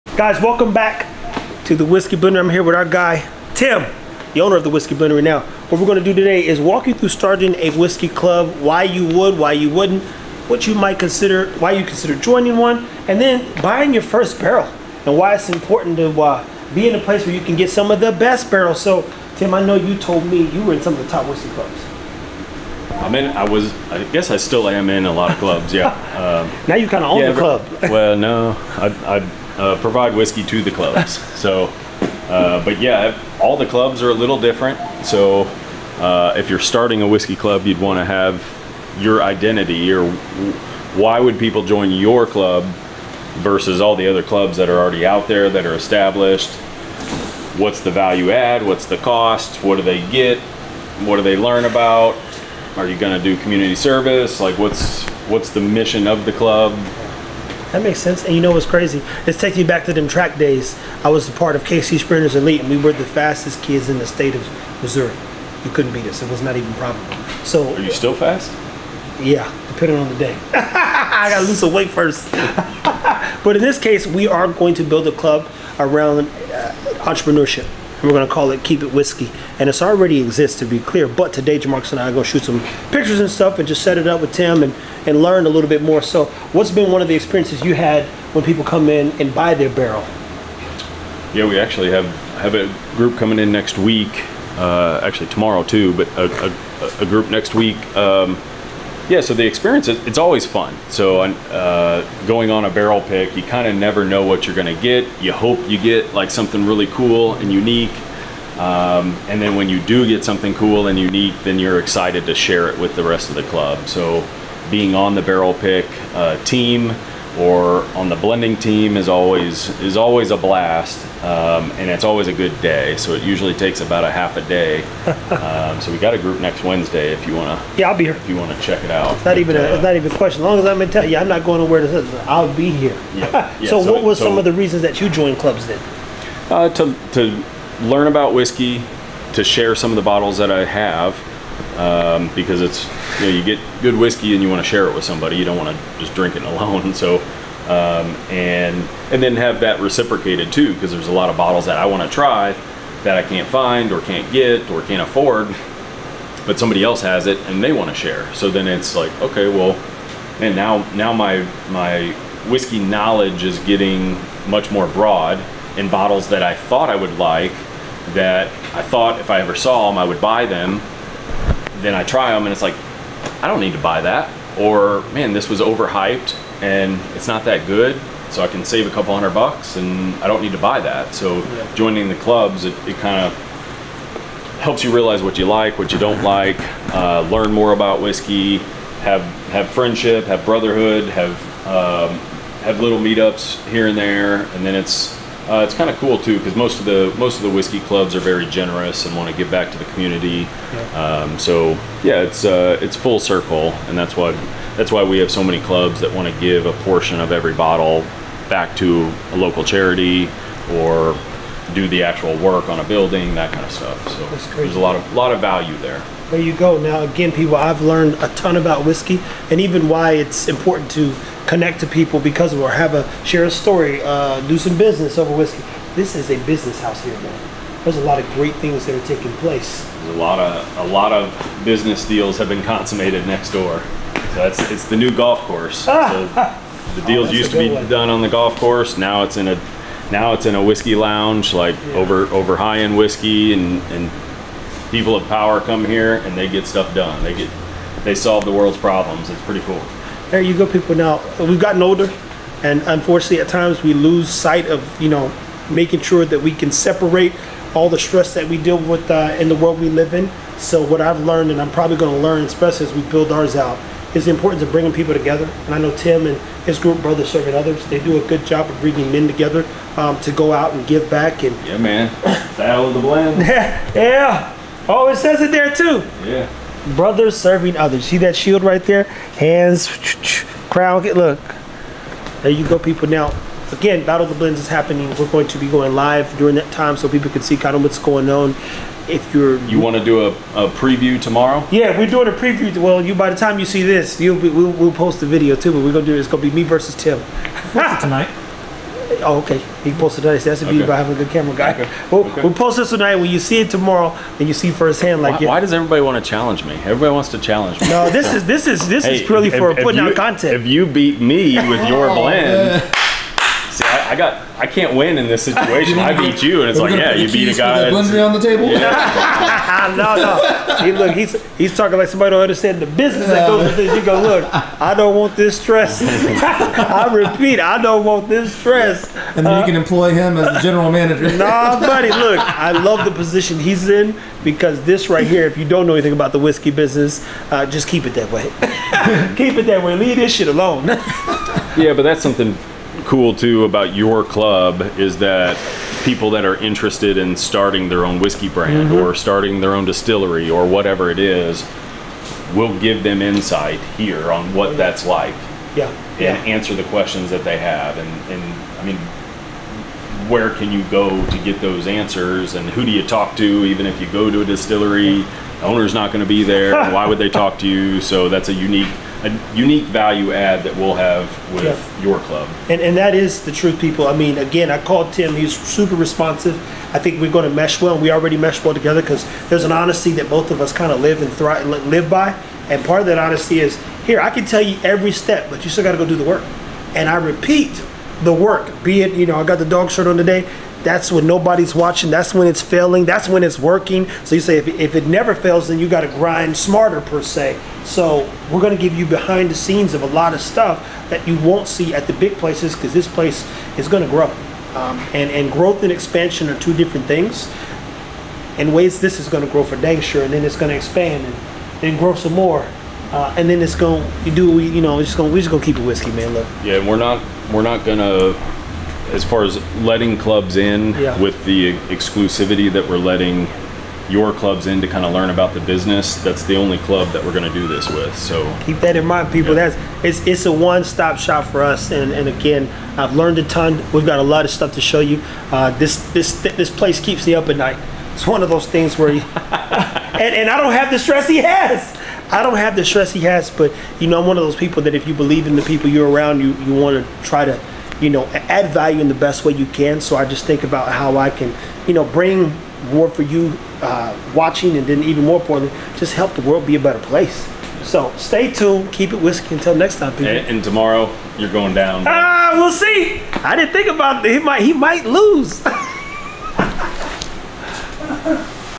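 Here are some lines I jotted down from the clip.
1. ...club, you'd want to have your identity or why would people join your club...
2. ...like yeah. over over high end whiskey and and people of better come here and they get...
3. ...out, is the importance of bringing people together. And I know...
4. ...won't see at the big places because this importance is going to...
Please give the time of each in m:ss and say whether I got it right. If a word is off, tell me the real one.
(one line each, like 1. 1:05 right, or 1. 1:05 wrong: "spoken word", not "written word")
1. 0:37 right
2. 4:01 wrong: "power", not "better"
3. 4:23 right
4. 6:41 wrong: "place", not "importance".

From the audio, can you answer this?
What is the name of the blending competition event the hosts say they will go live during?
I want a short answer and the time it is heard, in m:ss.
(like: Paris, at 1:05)
Battle of the Blends, at 4:44.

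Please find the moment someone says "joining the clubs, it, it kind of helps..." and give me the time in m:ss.
3:01.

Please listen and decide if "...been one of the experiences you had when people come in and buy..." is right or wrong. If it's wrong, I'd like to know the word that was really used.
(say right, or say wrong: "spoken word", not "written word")
right.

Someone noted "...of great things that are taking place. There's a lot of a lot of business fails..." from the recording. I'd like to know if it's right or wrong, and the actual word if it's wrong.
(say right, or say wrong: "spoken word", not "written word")
wrong: "deals", not "fails".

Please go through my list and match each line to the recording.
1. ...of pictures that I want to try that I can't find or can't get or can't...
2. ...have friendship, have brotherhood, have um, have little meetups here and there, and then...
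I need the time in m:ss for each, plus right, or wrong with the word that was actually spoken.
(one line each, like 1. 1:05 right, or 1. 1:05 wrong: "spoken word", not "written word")
1. 2:31 wrong: "bottles", not "pictures"
2. 3:09 right.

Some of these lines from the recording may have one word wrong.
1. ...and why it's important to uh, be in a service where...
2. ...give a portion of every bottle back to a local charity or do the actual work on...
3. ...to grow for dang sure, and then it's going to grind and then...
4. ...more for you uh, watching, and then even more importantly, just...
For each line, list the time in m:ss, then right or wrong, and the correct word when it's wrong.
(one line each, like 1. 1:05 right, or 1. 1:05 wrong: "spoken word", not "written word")
1. 0:15 wrong: "place", not "service"
2. 3:26 right
3. 6:49 wrong: "expand", not "grind"
4. 7:32 right.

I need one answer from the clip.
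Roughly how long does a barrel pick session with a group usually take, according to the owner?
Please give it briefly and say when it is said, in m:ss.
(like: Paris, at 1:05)
Half a day, at 2:04.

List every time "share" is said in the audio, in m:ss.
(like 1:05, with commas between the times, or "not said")
1:52, 2:19, 2:24, 2:37, 3:43.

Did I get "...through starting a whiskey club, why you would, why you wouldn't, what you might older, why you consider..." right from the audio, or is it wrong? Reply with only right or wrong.
wrong.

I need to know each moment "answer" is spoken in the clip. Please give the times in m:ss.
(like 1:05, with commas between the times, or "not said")
5:56, 6:01.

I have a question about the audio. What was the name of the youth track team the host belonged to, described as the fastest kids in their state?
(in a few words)
KC Sprinters Elite.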